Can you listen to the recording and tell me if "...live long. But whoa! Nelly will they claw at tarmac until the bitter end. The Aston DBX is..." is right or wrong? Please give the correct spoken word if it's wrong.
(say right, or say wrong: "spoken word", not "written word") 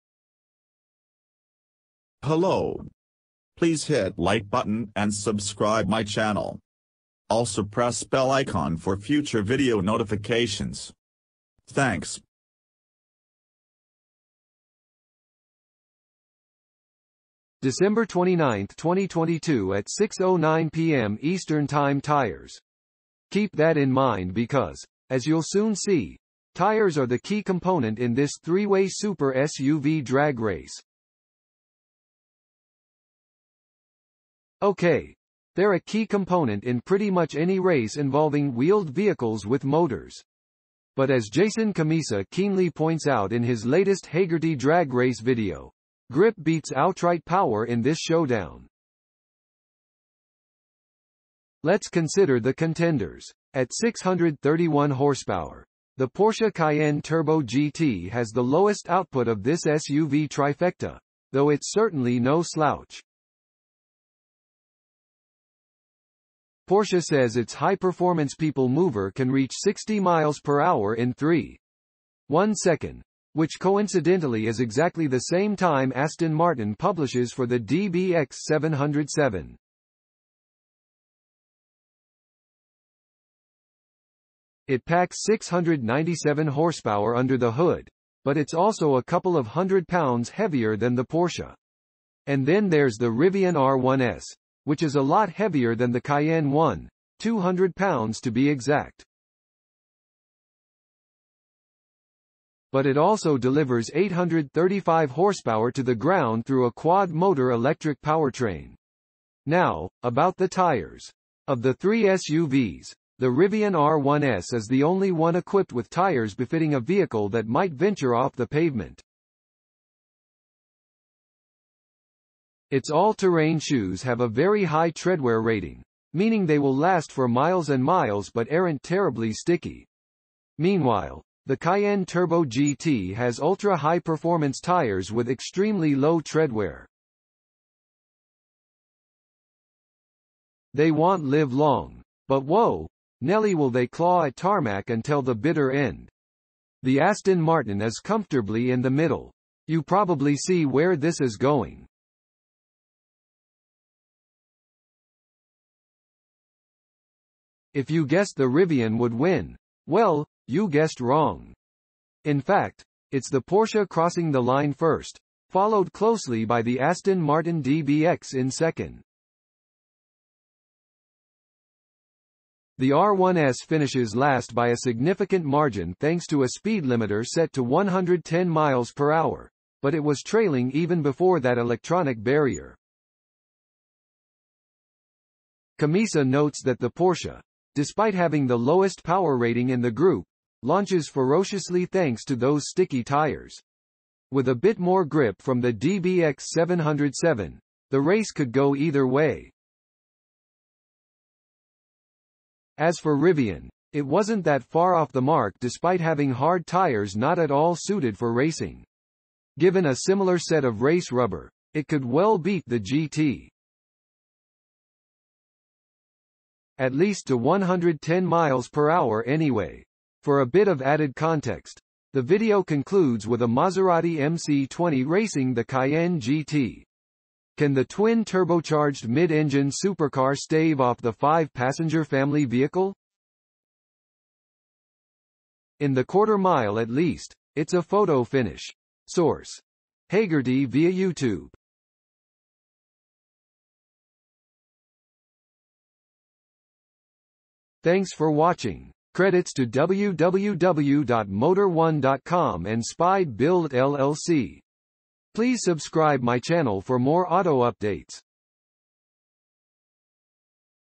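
wrong: "Martin", not "DBX".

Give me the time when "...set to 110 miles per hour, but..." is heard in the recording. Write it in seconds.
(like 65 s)
177 s.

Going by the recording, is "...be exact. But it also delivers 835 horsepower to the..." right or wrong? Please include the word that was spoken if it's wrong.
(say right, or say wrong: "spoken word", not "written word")
right.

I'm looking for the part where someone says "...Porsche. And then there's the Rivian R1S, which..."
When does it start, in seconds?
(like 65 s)
91 s.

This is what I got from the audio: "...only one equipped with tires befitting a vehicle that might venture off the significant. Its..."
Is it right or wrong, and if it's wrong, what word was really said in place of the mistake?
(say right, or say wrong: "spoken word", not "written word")
wrong: "pavement", not "significant".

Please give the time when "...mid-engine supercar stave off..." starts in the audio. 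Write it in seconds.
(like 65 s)
229 s.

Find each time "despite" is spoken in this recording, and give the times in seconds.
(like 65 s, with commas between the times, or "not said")
187 s, 205 s.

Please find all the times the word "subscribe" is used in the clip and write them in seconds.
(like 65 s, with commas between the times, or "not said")
5 s, 255 s.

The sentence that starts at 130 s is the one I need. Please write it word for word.
Meanwhile, the Cayenne Turbo GT has ultra-high performance tires with extremely low treadwear.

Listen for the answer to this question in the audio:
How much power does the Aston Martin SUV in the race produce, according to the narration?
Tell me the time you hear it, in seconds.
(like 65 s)
85 s.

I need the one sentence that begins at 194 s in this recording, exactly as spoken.
With a bit more grip from the DBX 707, the race could go either way.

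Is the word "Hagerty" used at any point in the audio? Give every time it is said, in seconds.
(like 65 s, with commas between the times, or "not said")
44 s, 240 s.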